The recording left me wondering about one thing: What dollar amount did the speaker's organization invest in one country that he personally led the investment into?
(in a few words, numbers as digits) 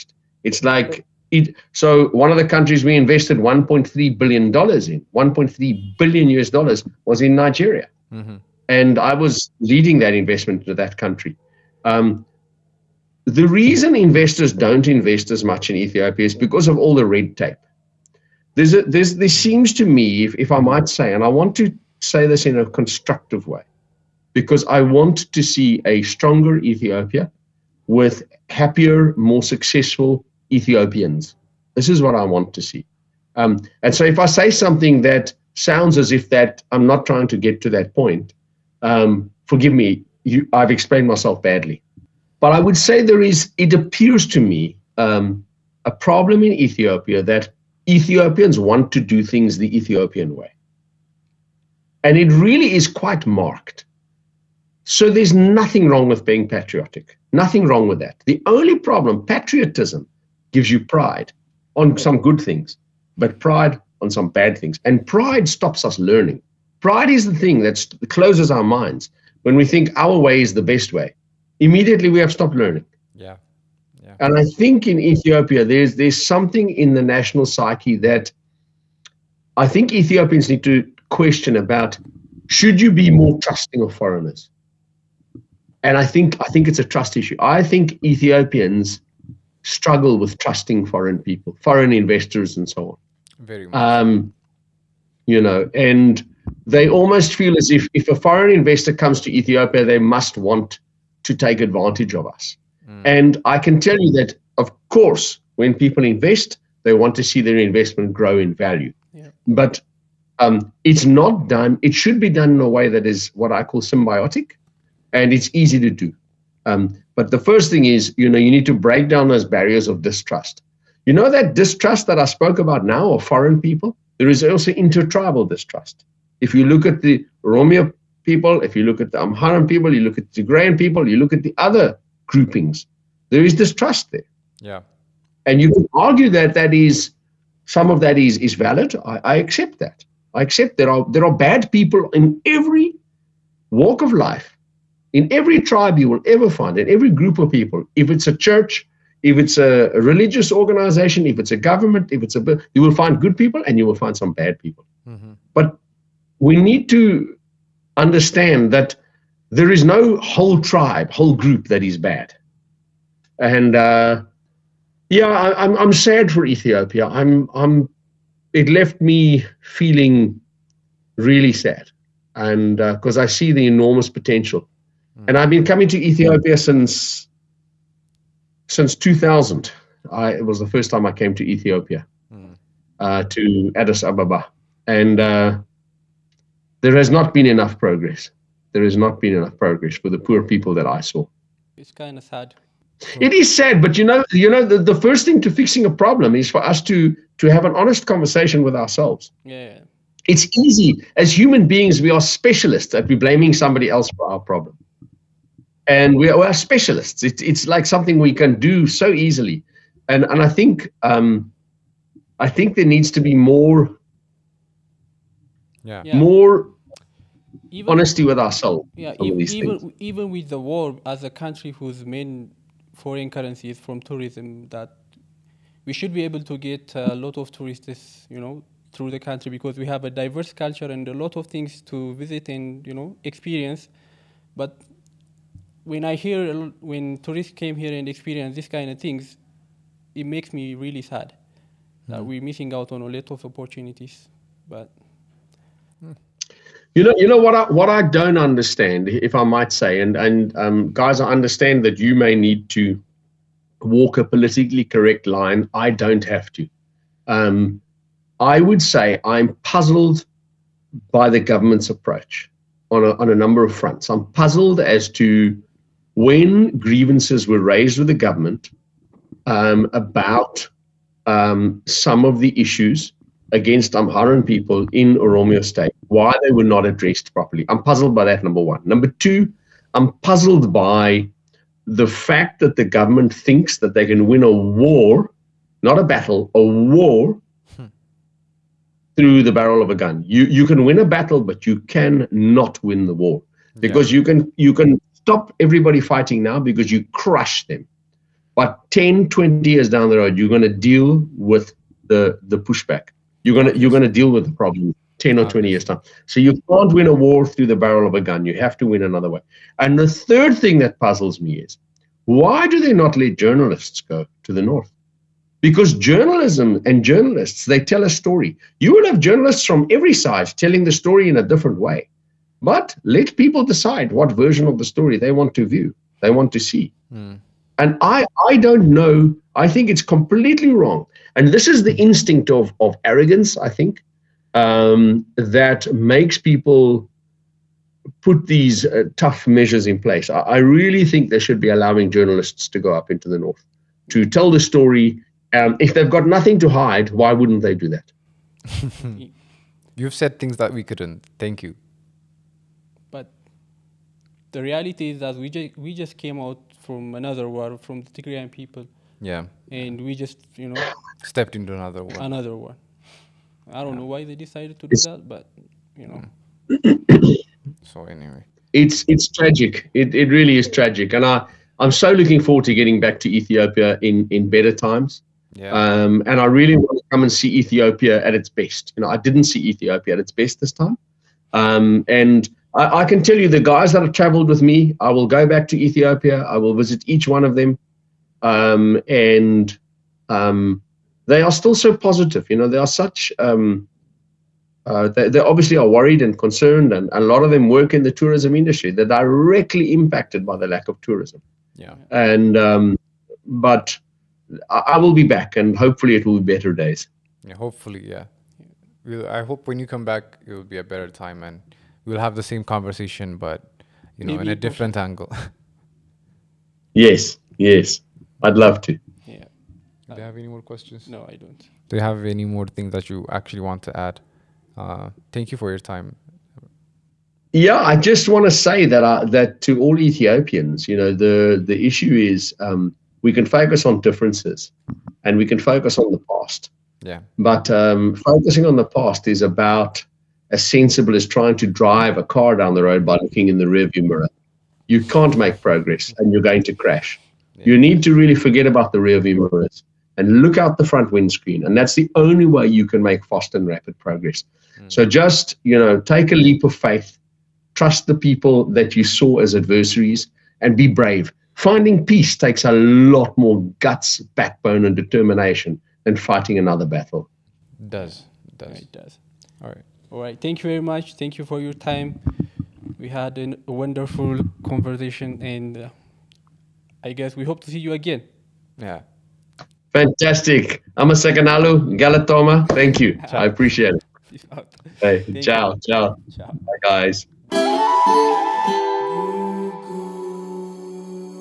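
$1.3 billion.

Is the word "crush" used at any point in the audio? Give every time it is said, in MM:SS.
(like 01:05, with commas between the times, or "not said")
04:57.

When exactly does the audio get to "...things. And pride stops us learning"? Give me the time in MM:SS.
01:04.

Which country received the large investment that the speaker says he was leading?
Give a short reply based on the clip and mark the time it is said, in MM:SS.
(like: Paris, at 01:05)
Nigeria, at 00:07.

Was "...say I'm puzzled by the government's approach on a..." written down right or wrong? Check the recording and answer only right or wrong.
right.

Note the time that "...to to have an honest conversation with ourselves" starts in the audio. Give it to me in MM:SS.
03:16.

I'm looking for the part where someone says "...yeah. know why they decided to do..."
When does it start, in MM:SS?
06:03.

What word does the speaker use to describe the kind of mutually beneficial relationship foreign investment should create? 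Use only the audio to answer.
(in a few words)
Symbiotic.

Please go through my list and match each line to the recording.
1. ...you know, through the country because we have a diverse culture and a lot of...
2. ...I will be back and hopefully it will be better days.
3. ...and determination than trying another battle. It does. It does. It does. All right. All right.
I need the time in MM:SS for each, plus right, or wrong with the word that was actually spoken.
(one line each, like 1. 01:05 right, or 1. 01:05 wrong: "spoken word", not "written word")
1. 03:48 right
2. 06:44 right
3. 07:44 wrong: "fighting", not "trying".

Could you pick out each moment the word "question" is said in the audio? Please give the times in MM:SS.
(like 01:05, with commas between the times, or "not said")
01:21, 07:00.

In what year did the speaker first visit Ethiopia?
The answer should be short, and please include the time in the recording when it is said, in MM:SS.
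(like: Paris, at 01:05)
2000, at 02:58.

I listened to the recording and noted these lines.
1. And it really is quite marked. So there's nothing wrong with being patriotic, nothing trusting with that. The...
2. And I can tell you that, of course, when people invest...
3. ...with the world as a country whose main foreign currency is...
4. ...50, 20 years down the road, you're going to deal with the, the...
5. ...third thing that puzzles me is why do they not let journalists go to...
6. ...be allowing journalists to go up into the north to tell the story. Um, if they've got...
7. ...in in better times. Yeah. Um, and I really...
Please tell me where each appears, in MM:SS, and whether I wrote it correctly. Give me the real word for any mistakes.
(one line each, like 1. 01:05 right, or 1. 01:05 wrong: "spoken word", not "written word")
1. 00:52 wrong: "wrong", not "trusting"
2. 01:43 right
3. 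03:40 right
4. 04:58 wrong: "10", not "50"
5. 05:10 right
6. 05:41 right
7. 06:14 right.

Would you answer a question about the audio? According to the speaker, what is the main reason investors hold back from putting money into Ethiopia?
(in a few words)
Red tape.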